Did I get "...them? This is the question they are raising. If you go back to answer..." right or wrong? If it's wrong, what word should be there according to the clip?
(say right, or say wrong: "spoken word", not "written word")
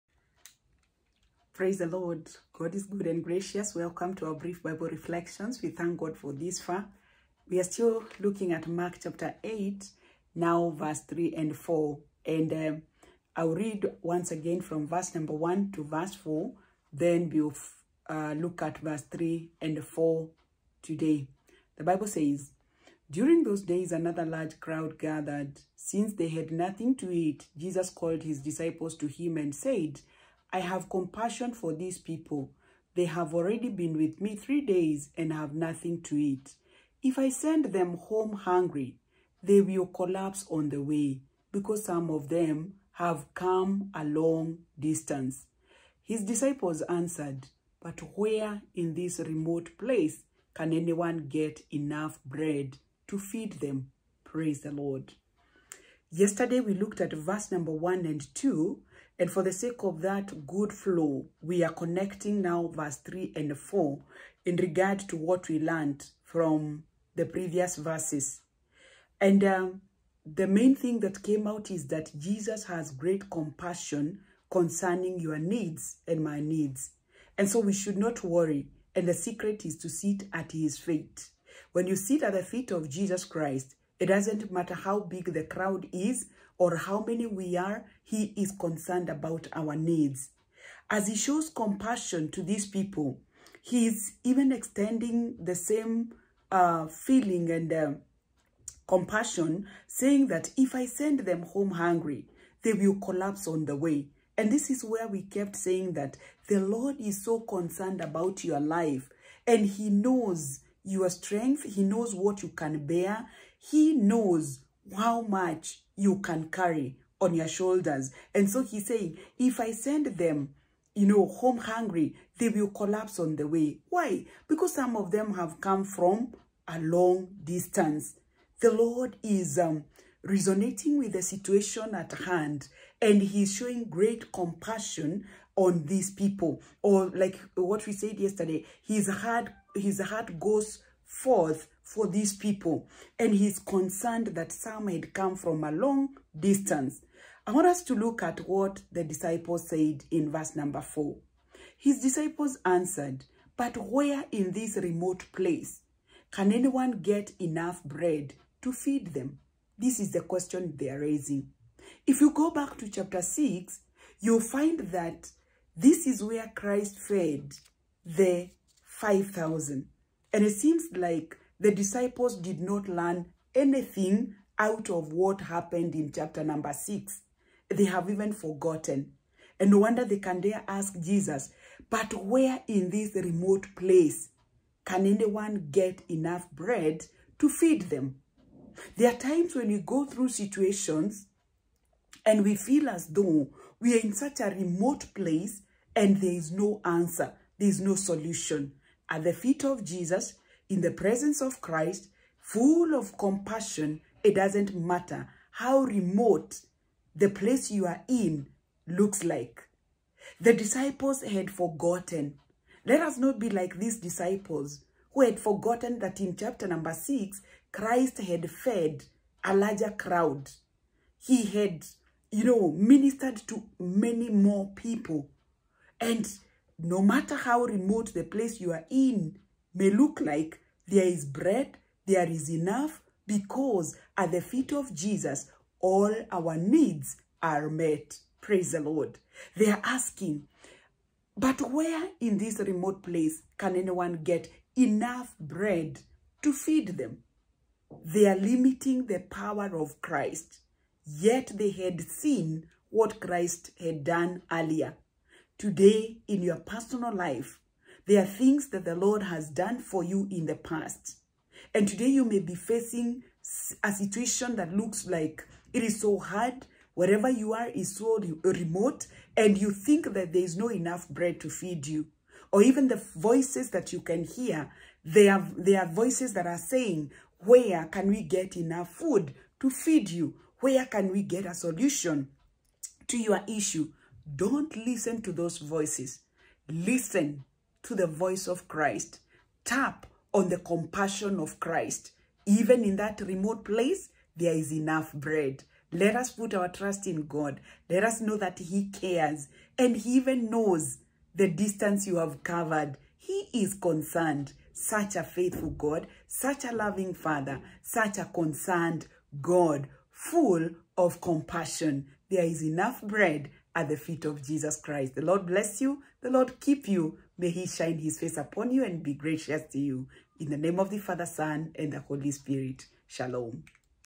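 wrong: "chapter", not "answer".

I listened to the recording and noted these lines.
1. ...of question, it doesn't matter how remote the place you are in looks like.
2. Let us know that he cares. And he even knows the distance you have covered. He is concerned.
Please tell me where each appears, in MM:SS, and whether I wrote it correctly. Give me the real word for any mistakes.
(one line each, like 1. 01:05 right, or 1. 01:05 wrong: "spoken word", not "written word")
1. 03:22 wrong: "compassion", not "question"
2. 04:57 right.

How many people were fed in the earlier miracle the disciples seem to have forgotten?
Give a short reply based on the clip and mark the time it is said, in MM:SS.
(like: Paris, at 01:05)
5,000, at 02:48.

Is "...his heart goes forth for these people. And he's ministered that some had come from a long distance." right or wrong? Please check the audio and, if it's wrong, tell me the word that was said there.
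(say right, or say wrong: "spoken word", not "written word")
wrong: "concerned", not "ministered".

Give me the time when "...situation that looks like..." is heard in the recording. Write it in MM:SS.
04:23.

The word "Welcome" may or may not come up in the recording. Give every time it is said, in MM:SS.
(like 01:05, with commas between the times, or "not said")
00:03.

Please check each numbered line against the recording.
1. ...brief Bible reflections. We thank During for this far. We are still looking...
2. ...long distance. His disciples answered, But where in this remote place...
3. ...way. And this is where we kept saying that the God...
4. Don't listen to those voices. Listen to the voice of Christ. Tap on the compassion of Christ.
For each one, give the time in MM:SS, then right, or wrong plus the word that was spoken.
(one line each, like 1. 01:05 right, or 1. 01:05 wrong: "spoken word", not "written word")
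1. 00:04 wrong: "God", not "During"
2. 00:44 right
3. 01:43 wrong: "Lord", not "God"
4. 04:44 right.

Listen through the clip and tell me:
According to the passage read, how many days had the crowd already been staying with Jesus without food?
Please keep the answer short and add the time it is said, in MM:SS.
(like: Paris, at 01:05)
3, at 00:34.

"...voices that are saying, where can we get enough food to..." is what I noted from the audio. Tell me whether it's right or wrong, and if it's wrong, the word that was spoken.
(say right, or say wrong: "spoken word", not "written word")
right.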